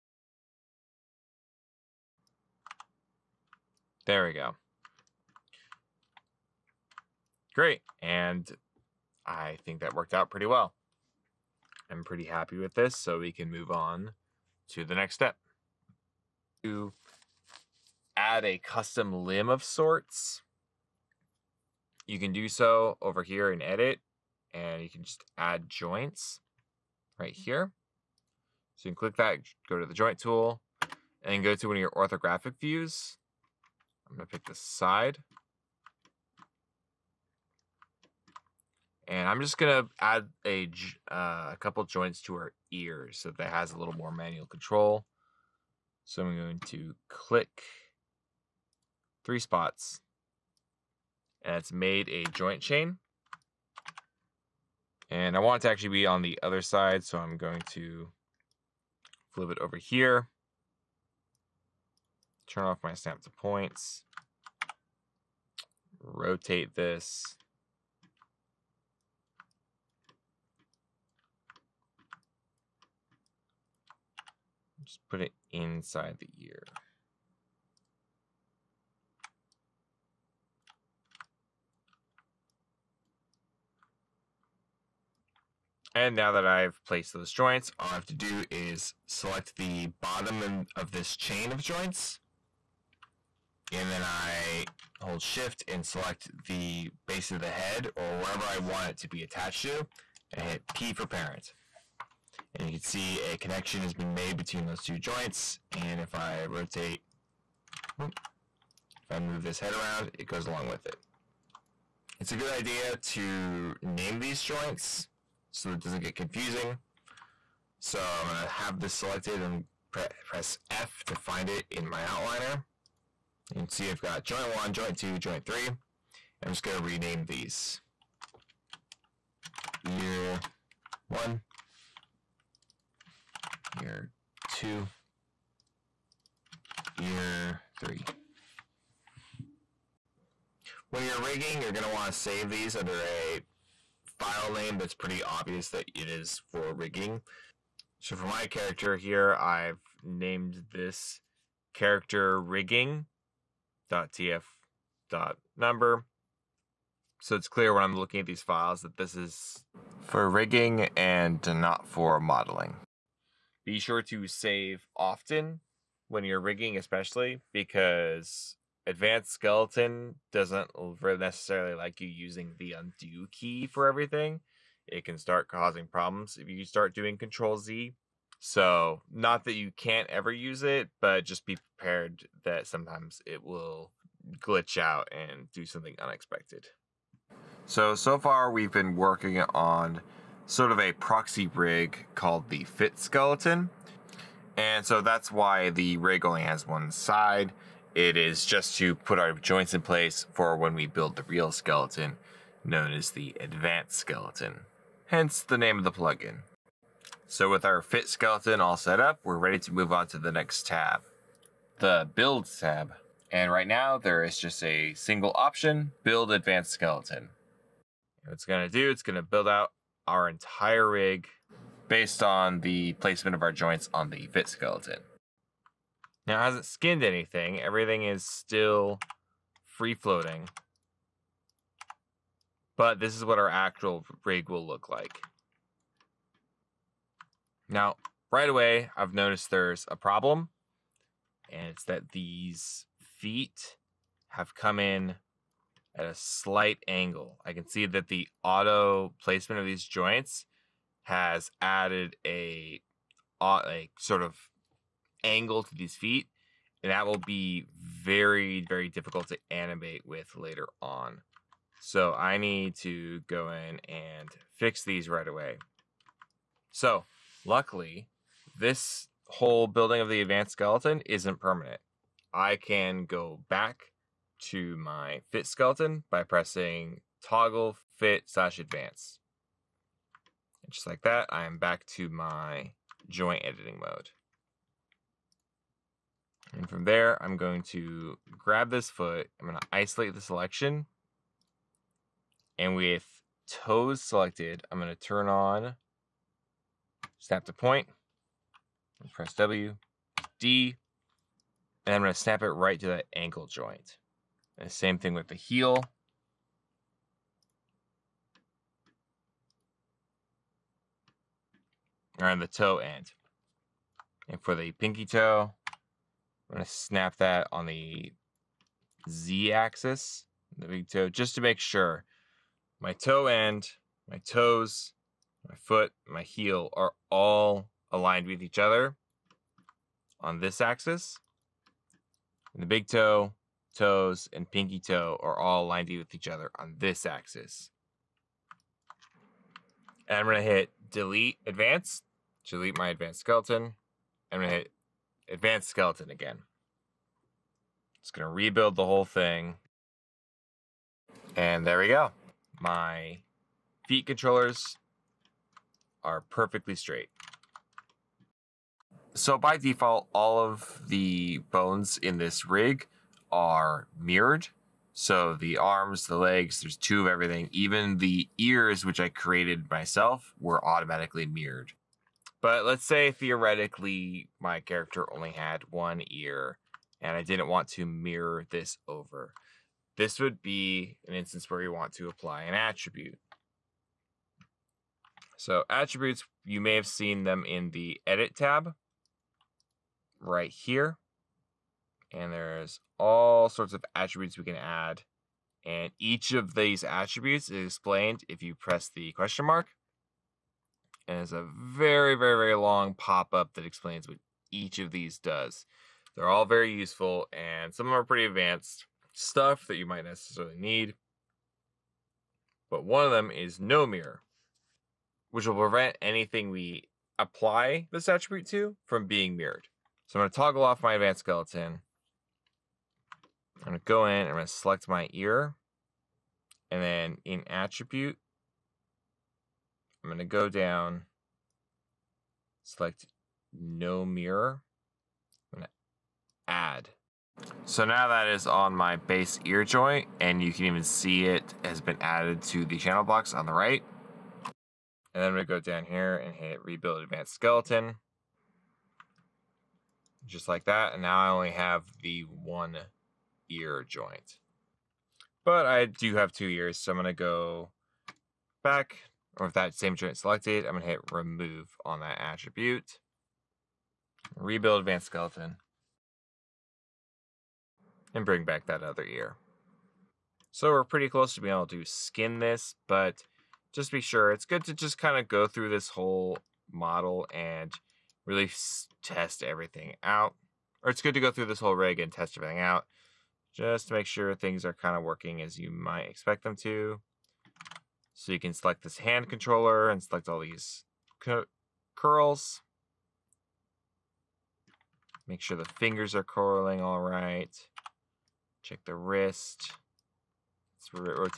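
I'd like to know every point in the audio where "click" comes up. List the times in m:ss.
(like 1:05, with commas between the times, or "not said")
0:28, 0:47.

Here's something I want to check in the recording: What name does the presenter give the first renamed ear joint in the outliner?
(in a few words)
Year one.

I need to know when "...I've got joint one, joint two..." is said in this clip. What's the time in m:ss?
2:03.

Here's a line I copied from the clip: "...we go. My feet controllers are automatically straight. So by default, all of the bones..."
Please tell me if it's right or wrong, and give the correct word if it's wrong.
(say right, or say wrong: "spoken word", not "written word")
wrong: "perfectly", not "automatically".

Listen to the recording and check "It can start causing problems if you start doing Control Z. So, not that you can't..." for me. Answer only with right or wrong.
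right.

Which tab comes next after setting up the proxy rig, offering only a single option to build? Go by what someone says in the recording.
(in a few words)
Build tab.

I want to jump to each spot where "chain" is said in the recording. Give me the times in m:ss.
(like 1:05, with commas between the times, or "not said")
0:52, 1:31.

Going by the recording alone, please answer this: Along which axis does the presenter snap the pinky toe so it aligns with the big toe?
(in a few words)
Z axis.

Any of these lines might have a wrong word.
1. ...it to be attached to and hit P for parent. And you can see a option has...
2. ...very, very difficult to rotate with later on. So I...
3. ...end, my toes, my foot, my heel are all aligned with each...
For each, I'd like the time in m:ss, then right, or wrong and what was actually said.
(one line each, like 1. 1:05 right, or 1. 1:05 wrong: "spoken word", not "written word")
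1. 1:38 wrong: "connection", not "option"
2. 4:17 wrong: "animate", not "rotate"
3. 5:23 right.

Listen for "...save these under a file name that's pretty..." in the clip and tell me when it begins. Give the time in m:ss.
2:22.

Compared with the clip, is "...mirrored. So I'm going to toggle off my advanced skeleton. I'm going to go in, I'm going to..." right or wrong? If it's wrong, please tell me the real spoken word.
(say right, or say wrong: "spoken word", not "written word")
right.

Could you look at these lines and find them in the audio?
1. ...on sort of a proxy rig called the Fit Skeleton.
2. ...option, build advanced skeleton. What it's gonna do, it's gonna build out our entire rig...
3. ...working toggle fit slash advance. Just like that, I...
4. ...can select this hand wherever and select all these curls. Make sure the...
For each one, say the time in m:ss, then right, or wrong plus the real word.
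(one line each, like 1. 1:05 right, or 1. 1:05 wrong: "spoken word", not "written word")
1. 3:09 right
2. 3:35 right
3. 4:36 wrong: "pressing", not "working"
4. 8:08 wrong: "controller", not "wherever".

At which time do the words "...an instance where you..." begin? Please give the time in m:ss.
6:21.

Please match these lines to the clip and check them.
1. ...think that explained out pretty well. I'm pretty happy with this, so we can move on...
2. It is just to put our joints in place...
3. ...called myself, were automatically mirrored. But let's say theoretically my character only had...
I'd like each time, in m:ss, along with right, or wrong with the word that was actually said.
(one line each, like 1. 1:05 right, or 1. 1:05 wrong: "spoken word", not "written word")
1. 0:09 wrong: "worked", not "explained"
2. 3:17 right
3. 6:09 wrong: "created", not "called".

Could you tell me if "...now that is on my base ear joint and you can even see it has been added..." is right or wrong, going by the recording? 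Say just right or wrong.
right.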